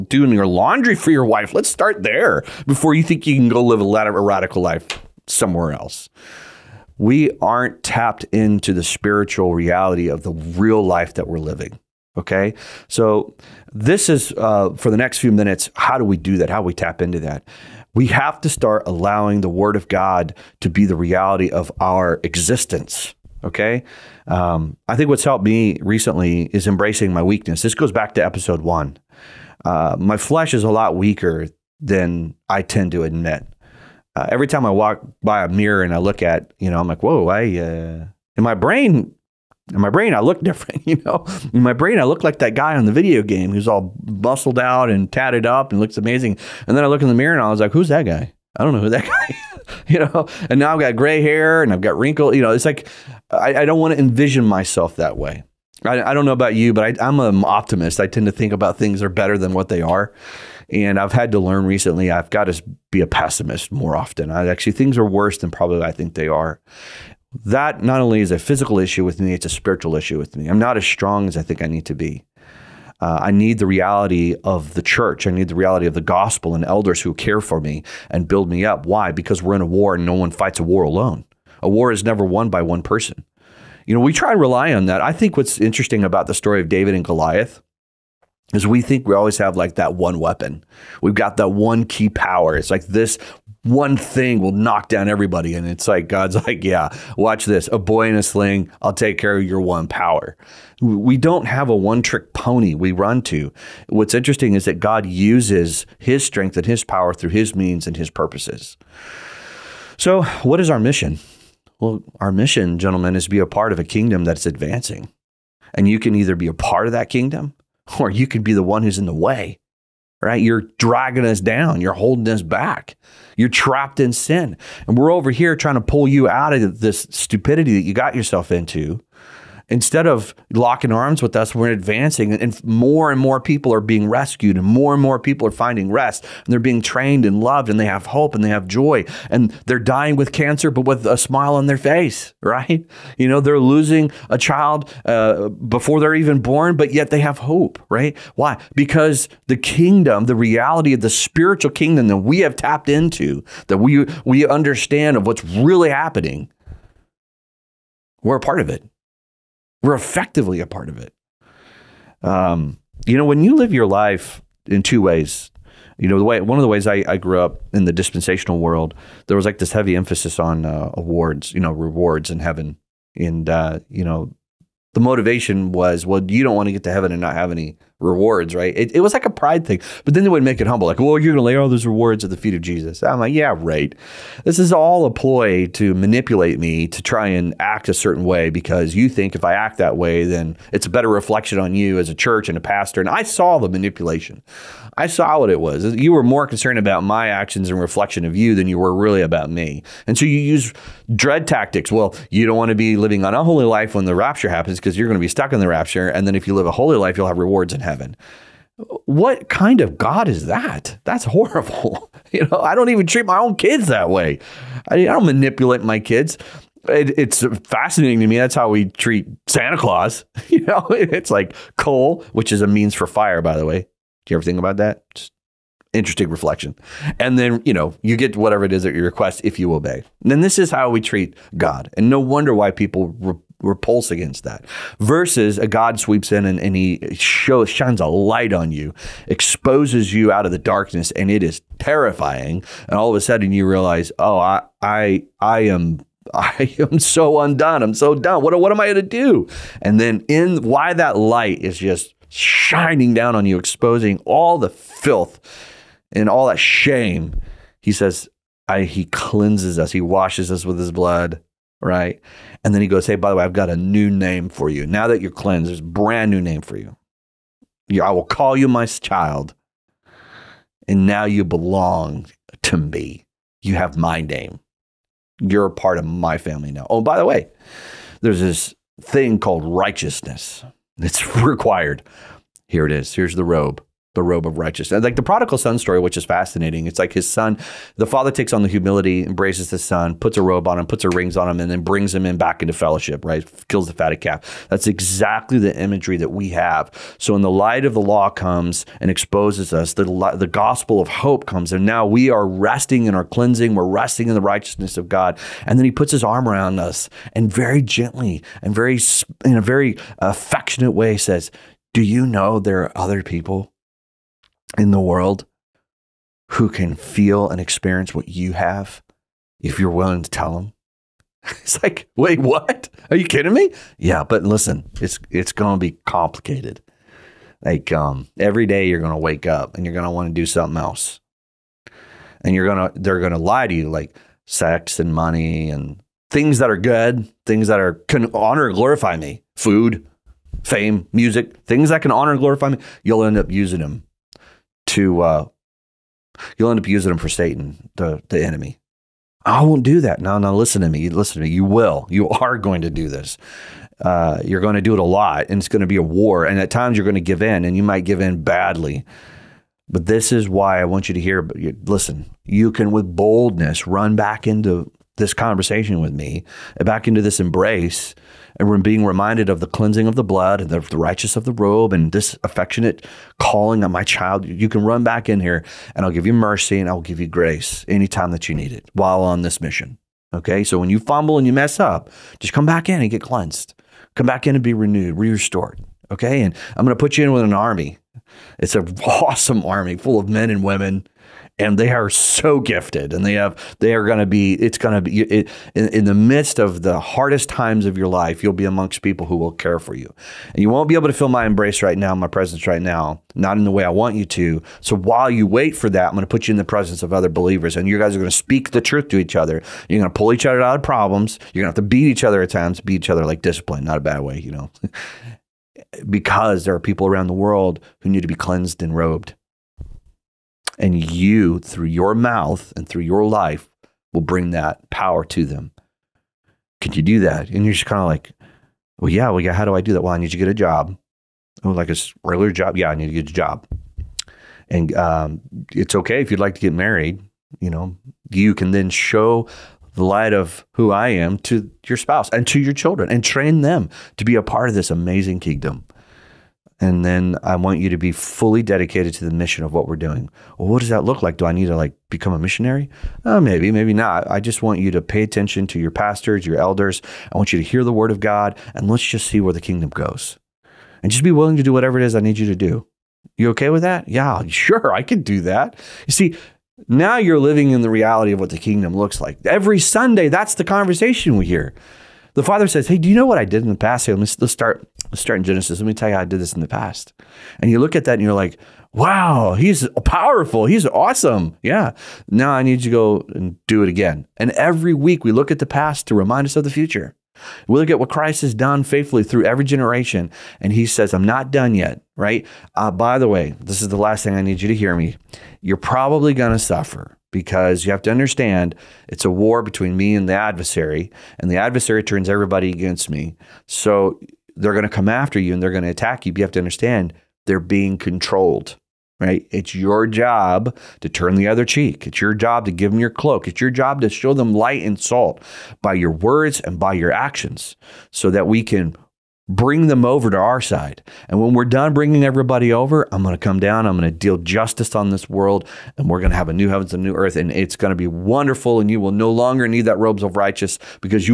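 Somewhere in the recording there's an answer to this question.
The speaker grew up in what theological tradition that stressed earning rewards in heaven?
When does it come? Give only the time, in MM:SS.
02:47.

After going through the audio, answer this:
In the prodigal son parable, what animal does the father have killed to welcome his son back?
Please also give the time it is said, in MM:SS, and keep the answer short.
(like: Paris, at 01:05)
fatted calf, at 04:53.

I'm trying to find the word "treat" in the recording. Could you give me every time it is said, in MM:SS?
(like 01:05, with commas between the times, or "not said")
03:33, 03:38, 03:51.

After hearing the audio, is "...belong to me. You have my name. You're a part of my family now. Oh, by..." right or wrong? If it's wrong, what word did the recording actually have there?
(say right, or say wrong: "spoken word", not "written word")
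right.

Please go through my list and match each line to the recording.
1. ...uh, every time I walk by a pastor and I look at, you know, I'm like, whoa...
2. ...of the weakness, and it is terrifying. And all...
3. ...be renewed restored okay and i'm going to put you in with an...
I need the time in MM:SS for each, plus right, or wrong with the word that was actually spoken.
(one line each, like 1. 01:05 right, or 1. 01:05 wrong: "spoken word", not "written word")
1. 00:34 wrong: "mirror", not "pastor"
2. 04:00 wrong: "darkness", not "weakness"
3. 06:24 right.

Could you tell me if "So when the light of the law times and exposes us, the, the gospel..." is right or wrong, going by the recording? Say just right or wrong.
wrong.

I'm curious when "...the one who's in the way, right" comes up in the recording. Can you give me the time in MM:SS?
01:58.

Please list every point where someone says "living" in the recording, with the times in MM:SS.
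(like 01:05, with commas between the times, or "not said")
00:11, 03:22, 07:47.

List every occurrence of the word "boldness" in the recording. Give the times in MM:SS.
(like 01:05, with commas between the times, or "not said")
06:03.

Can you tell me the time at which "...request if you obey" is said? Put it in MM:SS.
03:49.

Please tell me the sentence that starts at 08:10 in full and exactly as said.
And he says, I'm not done yet, right?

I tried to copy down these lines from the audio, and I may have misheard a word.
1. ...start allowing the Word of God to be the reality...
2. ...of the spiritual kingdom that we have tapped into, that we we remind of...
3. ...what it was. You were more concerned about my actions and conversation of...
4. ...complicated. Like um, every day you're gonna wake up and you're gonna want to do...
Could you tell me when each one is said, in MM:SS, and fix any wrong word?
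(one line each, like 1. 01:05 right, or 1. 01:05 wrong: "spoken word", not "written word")
1. 00:18 right
2. 02:30 wrong: "understand", not "remind"
3. 03:15 wrong: "reflection", not "conversation"
4. 05:26 right.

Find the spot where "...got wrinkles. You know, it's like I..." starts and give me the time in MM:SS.
00:51.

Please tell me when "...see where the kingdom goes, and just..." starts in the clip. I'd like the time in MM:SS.
07:39.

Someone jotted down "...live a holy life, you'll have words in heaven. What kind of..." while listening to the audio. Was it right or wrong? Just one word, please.
wrong.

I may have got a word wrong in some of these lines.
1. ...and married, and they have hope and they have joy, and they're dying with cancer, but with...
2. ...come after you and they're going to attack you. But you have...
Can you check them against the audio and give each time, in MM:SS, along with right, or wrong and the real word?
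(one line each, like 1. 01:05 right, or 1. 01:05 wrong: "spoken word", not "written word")
1. 02:17 wrong: "loved", not "married"
2. 08:24 right.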